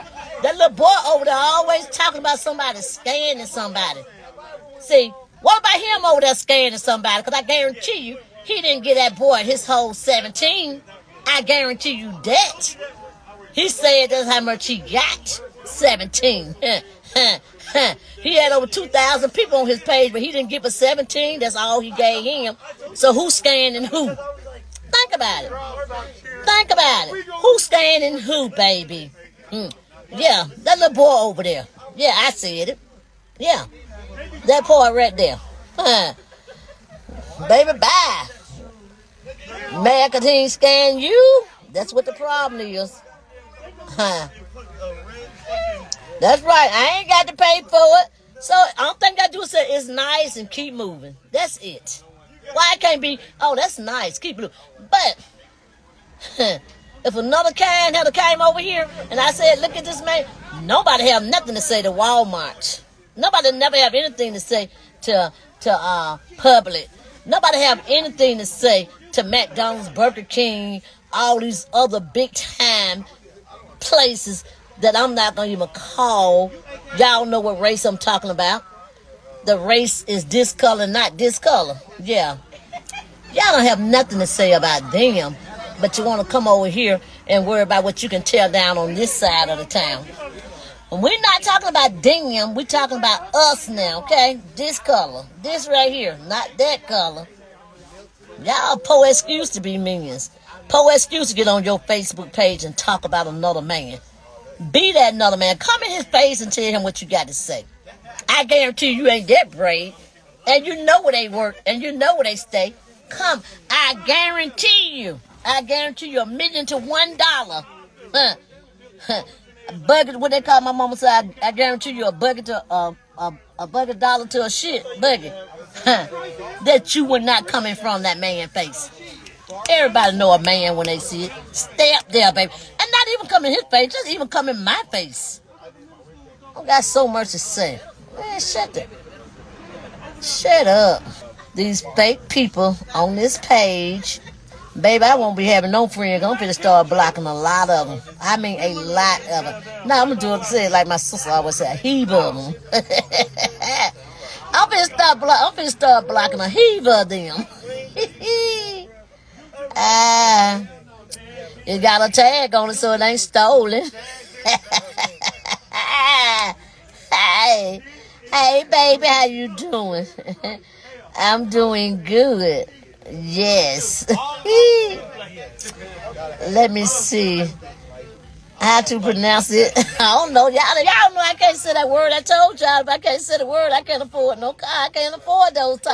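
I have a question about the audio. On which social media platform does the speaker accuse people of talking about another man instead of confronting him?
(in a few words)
Facebook.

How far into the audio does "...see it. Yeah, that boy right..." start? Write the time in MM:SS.
00:32.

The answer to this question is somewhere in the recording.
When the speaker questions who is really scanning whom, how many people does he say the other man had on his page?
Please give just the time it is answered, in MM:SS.
00:18.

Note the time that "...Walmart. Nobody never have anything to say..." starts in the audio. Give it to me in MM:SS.
01:01.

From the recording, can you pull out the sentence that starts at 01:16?
Y'all know what race I'm talking about the race is this color, not this color.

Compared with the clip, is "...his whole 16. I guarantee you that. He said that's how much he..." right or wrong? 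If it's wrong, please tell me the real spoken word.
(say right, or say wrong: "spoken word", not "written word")
wrong: "17", not "16".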